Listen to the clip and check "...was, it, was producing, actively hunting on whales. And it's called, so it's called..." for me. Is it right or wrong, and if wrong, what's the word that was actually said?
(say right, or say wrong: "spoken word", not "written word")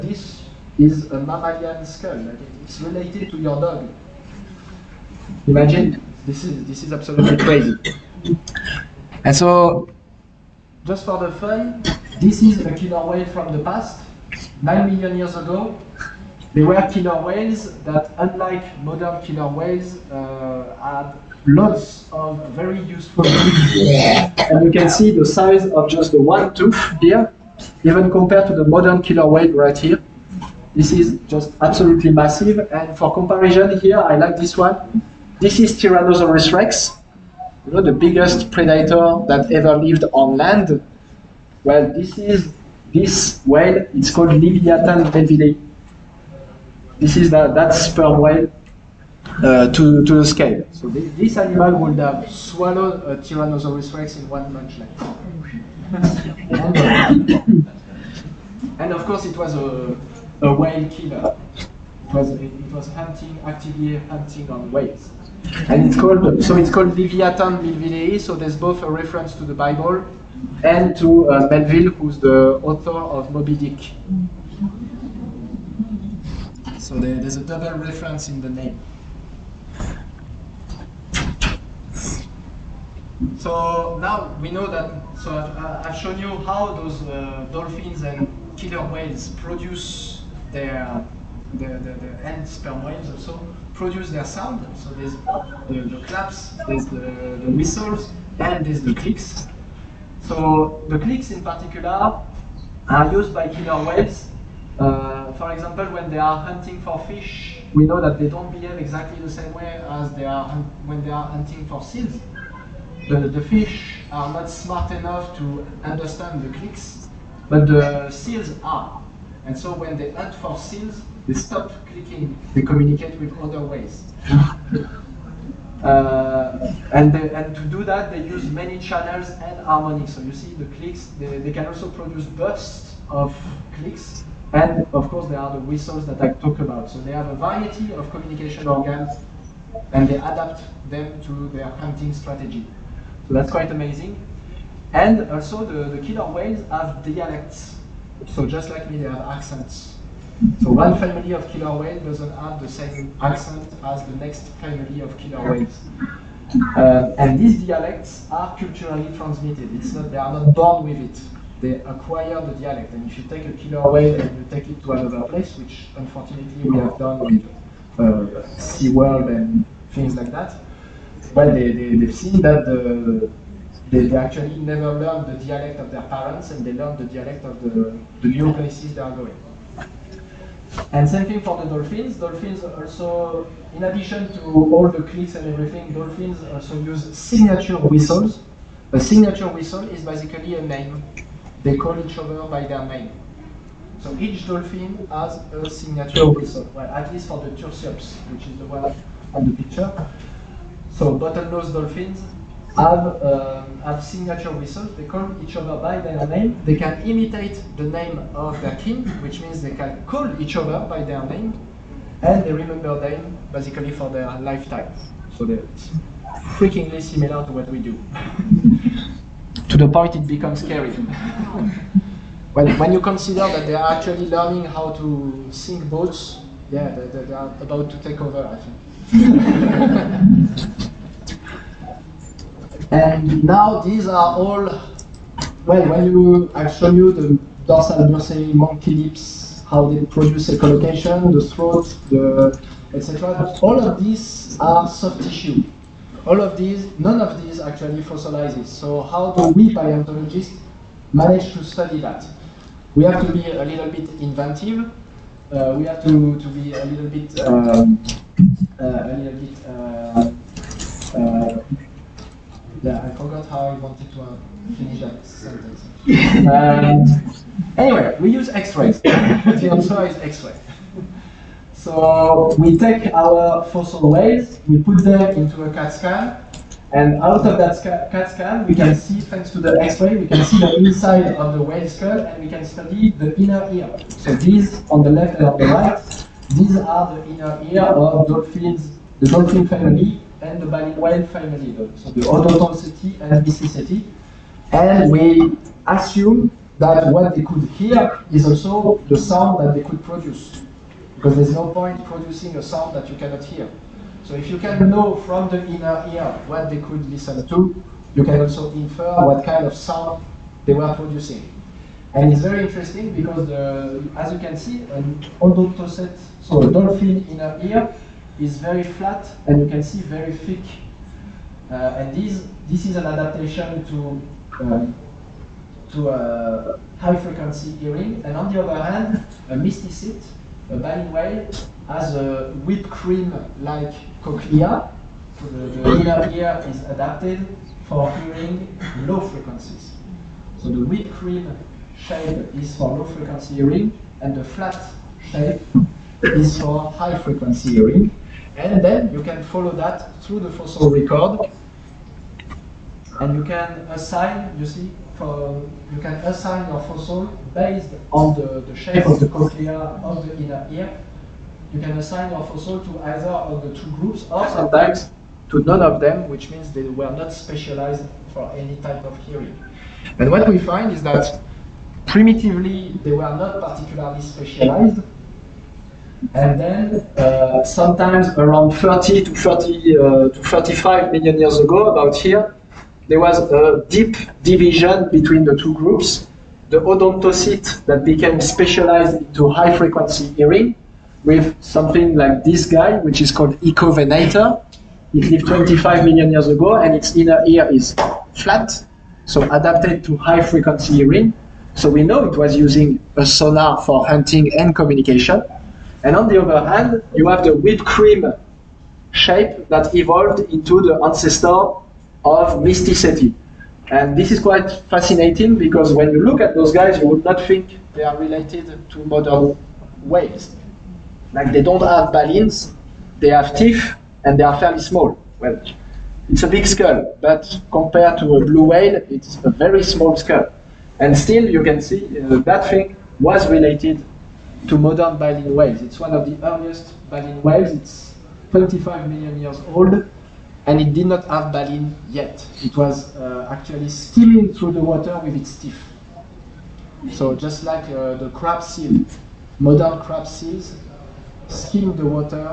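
wrong: "hunting", not "producing".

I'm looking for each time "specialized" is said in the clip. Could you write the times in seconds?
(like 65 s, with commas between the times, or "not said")
367 s, 374 s, 388 s.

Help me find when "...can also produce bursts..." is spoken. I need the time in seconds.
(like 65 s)
131 s.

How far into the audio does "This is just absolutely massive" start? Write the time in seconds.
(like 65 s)
30 s.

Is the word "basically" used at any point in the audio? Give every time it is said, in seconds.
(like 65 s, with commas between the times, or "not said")
190 s, 213 s.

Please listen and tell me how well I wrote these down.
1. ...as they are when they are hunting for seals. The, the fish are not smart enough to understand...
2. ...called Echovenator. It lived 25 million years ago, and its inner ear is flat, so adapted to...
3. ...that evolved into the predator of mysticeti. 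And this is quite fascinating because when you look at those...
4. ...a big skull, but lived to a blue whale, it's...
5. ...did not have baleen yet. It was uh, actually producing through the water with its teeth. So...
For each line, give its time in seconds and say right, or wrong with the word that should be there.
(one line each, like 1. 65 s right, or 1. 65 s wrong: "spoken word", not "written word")
1. 109 s right
2. 393 s right
3. 409 s wrong: "ancestor", not "predator"
4. 426 s wrong: "compared", not "lived"
5. 440 s wrong: "steaming", not "producing".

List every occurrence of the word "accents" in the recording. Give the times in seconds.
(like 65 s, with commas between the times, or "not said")
149 s, 153 s.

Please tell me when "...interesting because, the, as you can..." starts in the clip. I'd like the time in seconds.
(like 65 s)
312 s.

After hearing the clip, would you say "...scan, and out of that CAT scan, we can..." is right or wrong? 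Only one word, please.
right.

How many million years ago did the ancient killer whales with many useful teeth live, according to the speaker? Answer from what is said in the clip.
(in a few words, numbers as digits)
9.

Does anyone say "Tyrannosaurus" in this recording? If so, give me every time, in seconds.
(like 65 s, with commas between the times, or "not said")
35 s, 53 s.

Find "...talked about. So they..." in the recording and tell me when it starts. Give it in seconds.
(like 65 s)
136 s.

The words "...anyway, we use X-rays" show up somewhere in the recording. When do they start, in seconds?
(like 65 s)
267 s.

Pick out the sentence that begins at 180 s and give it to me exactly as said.
And same thing for the dolphins.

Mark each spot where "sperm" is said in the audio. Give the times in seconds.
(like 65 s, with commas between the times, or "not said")
47 s, 92 s.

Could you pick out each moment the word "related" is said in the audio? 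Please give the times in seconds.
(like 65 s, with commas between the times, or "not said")
2 s, 418 s, 433 s.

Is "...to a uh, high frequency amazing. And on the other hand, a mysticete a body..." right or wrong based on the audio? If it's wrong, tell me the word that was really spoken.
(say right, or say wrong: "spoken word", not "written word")
wrong: "hearing", not "amazing".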